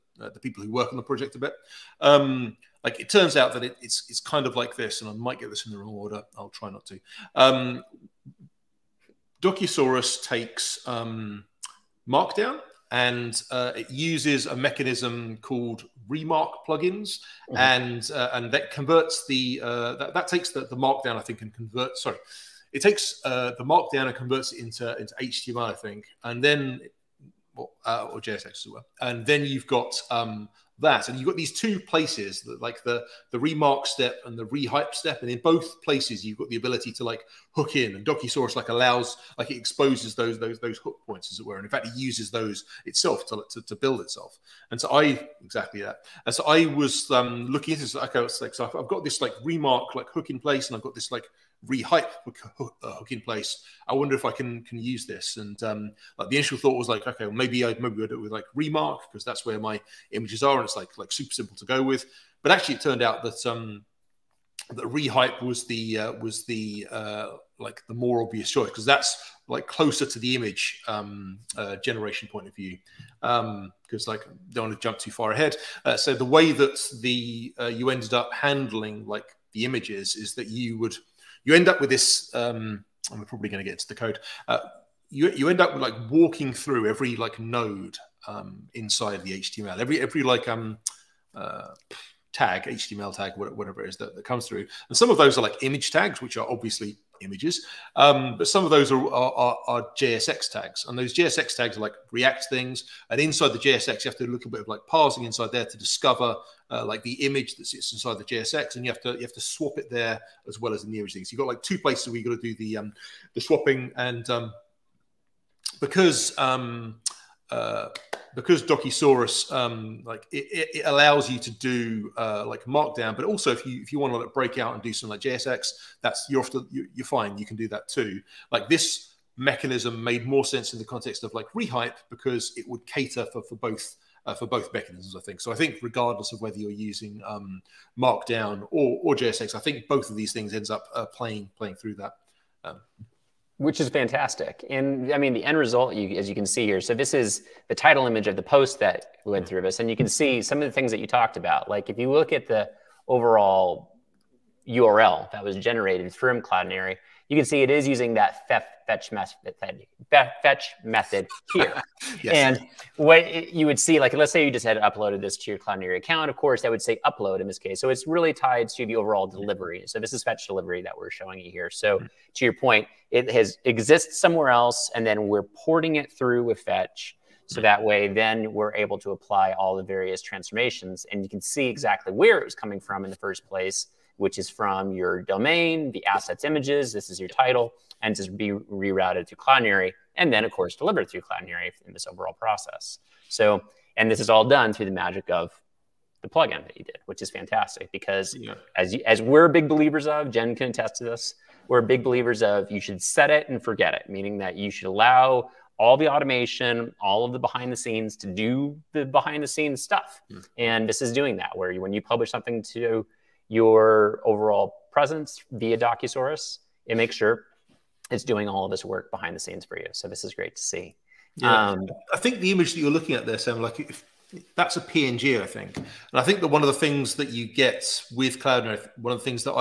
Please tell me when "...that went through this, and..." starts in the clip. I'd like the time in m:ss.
2:28.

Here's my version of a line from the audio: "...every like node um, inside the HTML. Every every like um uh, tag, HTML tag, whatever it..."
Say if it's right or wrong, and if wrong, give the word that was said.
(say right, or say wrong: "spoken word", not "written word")
right.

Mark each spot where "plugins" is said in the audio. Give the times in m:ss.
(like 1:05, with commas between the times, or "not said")
0:16, 3:16.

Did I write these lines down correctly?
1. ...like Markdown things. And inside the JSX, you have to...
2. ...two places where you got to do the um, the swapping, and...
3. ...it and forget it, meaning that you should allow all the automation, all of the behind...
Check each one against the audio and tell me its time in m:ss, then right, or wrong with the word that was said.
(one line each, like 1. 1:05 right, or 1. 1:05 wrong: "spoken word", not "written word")
1. 1:41 wrong: "React", not "Markdown"
2. 1:51 right
3. 3:23 right.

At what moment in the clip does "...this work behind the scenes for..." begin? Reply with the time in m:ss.
3:38.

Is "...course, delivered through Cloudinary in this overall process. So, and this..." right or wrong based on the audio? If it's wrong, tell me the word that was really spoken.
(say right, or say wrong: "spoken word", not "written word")
right.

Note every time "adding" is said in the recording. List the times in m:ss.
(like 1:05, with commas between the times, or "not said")
not said.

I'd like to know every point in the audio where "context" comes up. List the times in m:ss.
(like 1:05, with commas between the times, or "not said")
2:10.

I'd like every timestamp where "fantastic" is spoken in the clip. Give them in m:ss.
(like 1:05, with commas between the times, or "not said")
2:23, 3:17.